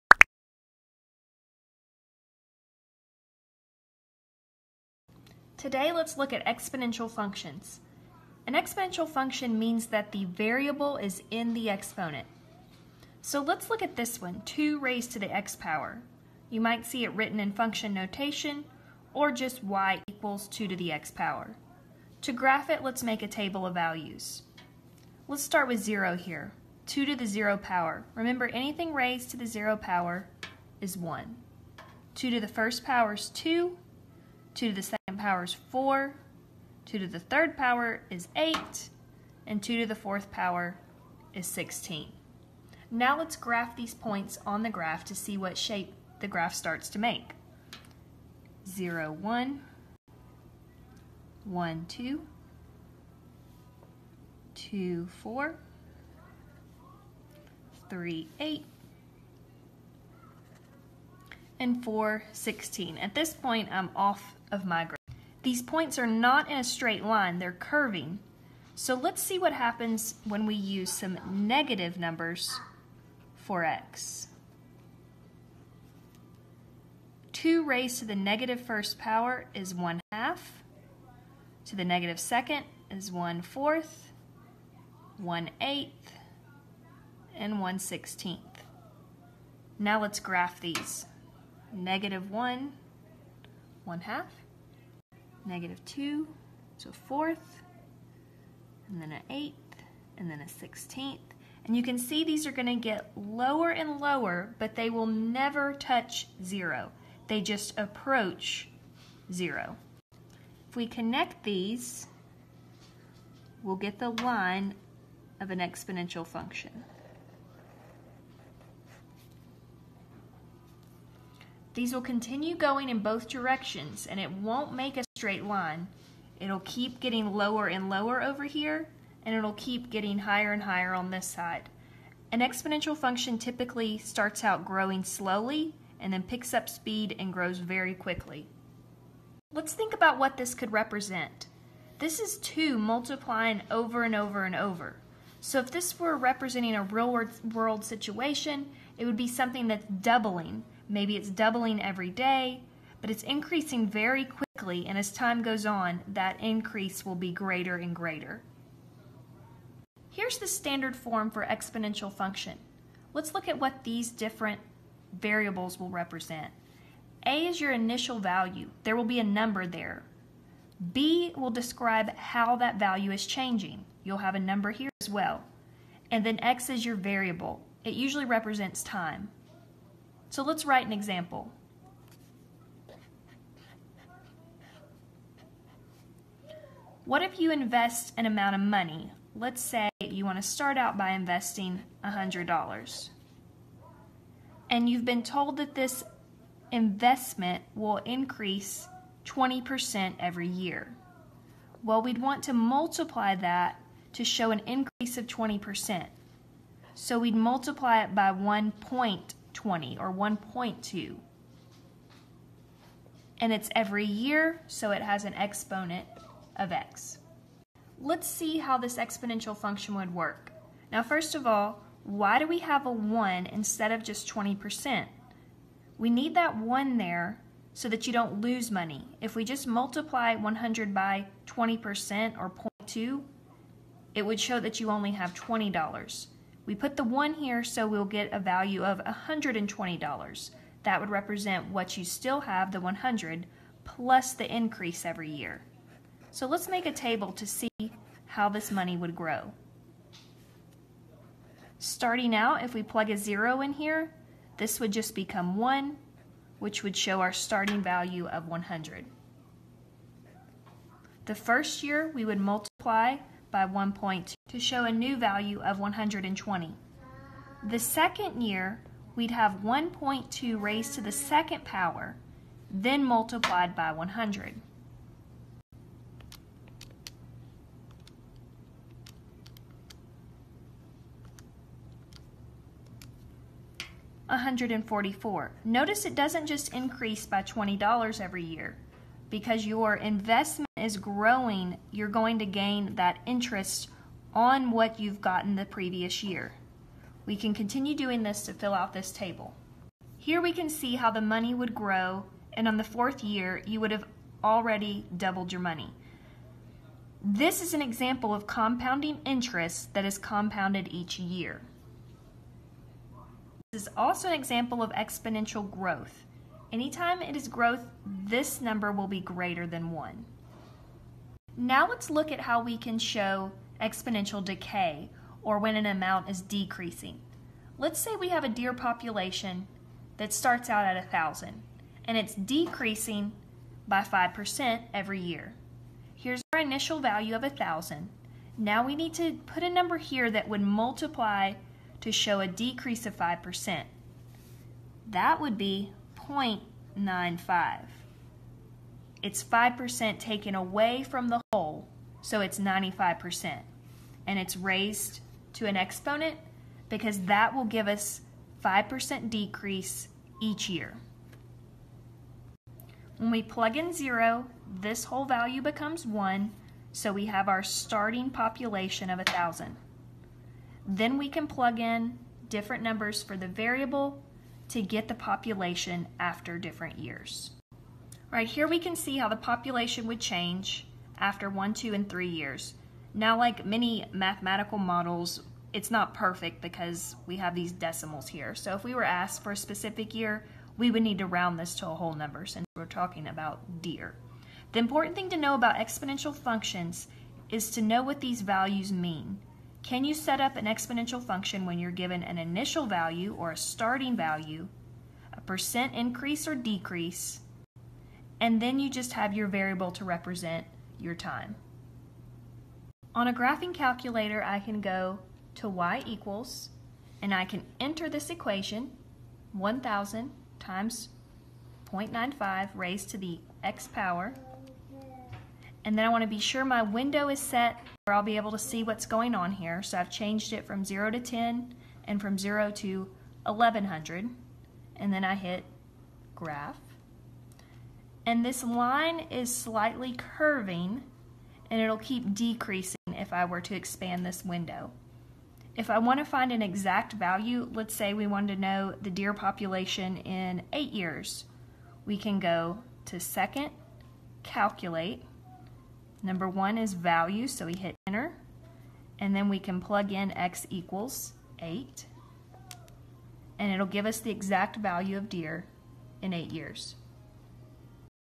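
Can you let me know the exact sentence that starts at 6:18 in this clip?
Right here we can see how the population would change after one, two, and three years.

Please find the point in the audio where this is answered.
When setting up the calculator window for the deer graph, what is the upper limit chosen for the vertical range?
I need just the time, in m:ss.
7:13.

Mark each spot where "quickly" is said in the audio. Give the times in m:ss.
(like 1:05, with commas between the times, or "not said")
2:17, 2:34.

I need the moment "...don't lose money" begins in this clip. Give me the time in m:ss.
3:48.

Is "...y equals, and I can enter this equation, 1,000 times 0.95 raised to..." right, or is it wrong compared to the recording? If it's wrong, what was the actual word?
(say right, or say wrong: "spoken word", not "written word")
right.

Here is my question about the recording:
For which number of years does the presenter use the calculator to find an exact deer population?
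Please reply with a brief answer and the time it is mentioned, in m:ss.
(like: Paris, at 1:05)
8, at 7:30.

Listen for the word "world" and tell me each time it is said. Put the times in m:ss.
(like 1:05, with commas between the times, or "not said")
2:27.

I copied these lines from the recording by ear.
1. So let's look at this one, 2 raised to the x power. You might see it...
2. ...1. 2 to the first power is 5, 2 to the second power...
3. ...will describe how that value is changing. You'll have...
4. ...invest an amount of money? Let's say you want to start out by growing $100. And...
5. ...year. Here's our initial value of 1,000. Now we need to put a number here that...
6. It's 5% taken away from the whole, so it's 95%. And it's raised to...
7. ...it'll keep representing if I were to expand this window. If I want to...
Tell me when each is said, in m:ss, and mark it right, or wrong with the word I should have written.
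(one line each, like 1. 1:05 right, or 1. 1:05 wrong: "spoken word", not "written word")
1. 0:13 right
2. 0:30 wrong: "2", not "5"
3. 2:51 right
4. 3:07 wrong: "investing", not "growing"
5. 5:35 right
6. 5:49 right
7. 7:21 wrong: "decreasing", not "representing".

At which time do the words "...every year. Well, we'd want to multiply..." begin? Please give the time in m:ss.
3:20.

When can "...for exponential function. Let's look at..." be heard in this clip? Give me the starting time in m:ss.
2:41.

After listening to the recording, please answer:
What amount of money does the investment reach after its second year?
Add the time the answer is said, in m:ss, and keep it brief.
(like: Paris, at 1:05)
144, at 4:44.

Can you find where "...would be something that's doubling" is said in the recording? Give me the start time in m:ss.
2:29.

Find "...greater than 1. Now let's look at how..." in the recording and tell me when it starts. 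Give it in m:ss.
5:19.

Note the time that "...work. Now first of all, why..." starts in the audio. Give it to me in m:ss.
3:40.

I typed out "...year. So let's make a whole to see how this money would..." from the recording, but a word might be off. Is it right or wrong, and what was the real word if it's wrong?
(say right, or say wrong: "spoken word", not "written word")
wrong: "table", not "whole".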